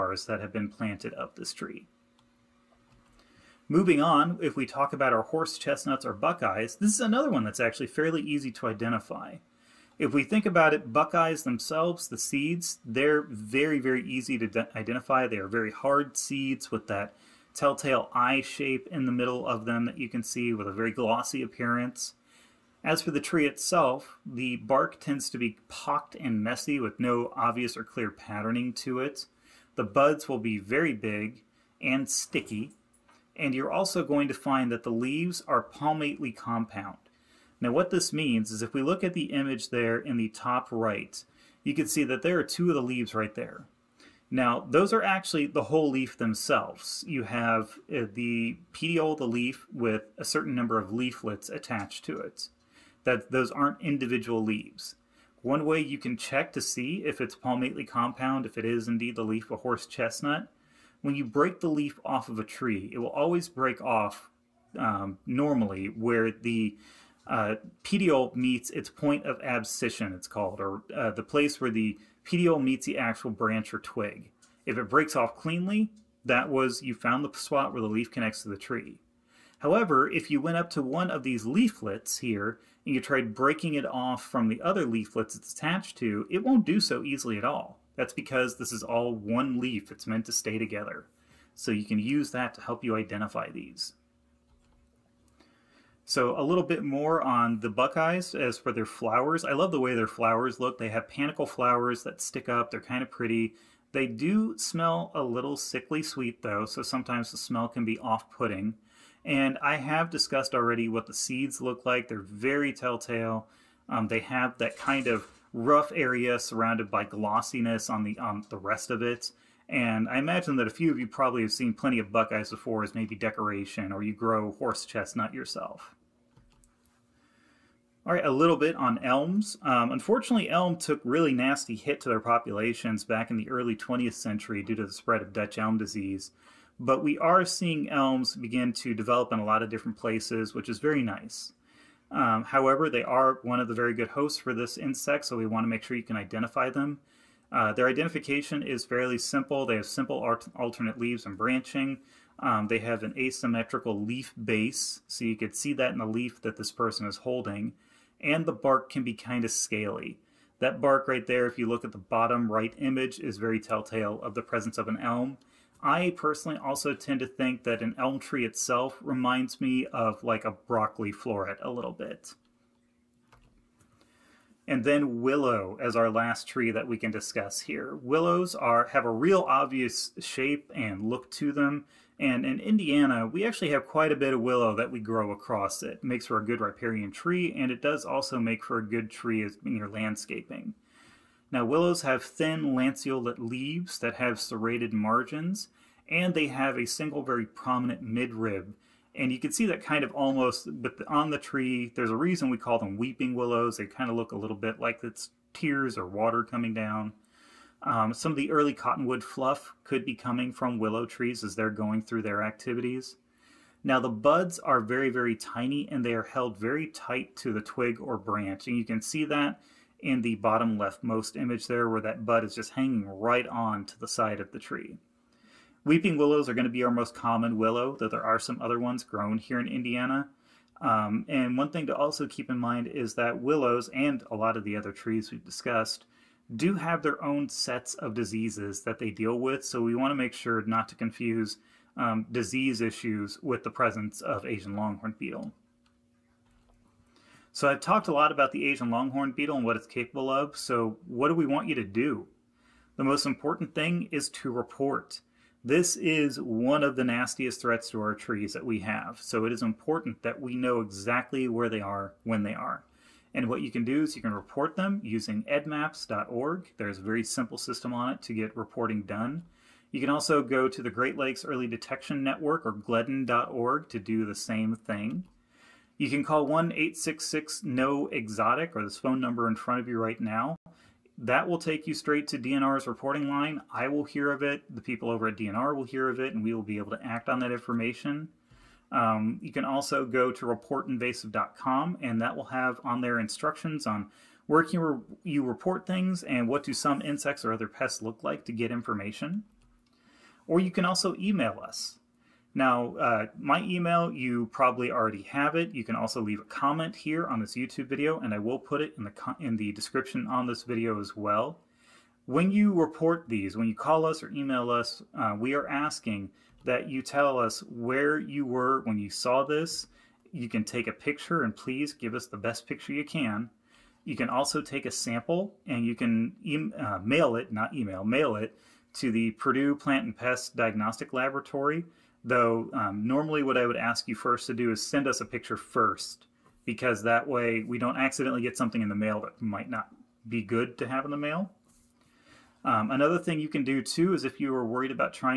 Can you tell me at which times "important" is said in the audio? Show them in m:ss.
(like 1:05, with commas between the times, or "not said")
4:13, 4:19.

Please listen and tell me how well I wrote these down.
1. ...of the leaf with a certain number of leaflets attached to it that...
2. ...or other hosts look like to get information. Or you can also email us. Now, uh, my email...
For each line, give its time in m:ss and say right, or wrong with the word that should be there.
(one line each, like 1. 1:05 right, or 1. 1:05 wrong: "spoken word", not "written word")
1. 0:49 right
2. 4:57 wrong: "pests", not "hosts".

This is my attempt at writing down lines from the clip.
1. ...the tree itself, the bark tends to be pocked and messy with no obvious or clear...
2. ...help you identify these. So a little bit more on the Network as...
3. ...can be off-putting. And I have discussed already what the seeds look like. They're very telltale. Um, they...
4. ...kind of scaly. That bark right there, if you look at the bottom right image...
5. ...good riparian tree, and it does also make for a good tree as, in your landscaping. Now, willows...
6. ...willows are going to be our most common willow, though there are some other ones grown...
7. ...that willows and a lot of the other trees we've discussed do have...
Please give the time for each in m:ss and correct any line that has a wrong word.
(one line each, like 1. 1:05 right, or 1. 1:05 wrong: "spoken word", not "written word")
1. 0:23 right
2. 1:32 wrong: "Buckeyes", not "Network"
3. 1:47 right
4. 2:39 right
5. 3:06 right
6. 3:46 right
7. 3:53 right.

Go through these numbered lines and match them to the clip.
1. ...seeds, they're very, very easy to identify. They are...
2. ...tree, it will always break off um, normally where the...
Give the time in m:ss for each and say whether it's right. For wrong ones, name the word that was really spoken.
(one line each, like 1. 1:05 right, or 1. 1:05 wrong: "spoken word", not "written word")
1. 0:12 right
2. 1:02 right.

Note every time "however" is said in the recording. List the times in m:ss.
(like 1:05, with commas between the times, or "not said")
1:19, 2:22.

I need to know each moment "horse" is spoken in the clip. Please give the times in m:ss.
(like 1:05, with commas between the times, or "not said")
0:05, 0:59, 2:04.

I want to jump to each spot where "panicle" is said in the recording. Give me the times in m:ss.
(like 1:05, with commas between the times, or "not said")
1:41.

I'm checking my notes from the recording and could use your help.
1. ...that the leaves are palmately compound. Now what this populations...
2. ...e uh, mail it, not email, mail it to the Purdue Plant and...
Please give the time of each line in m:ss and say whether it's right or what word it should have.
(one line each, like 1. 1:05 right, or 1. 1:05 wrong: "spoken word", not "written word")
1. 0:34 wrong: "means", not "populations"
2. 5:26 right.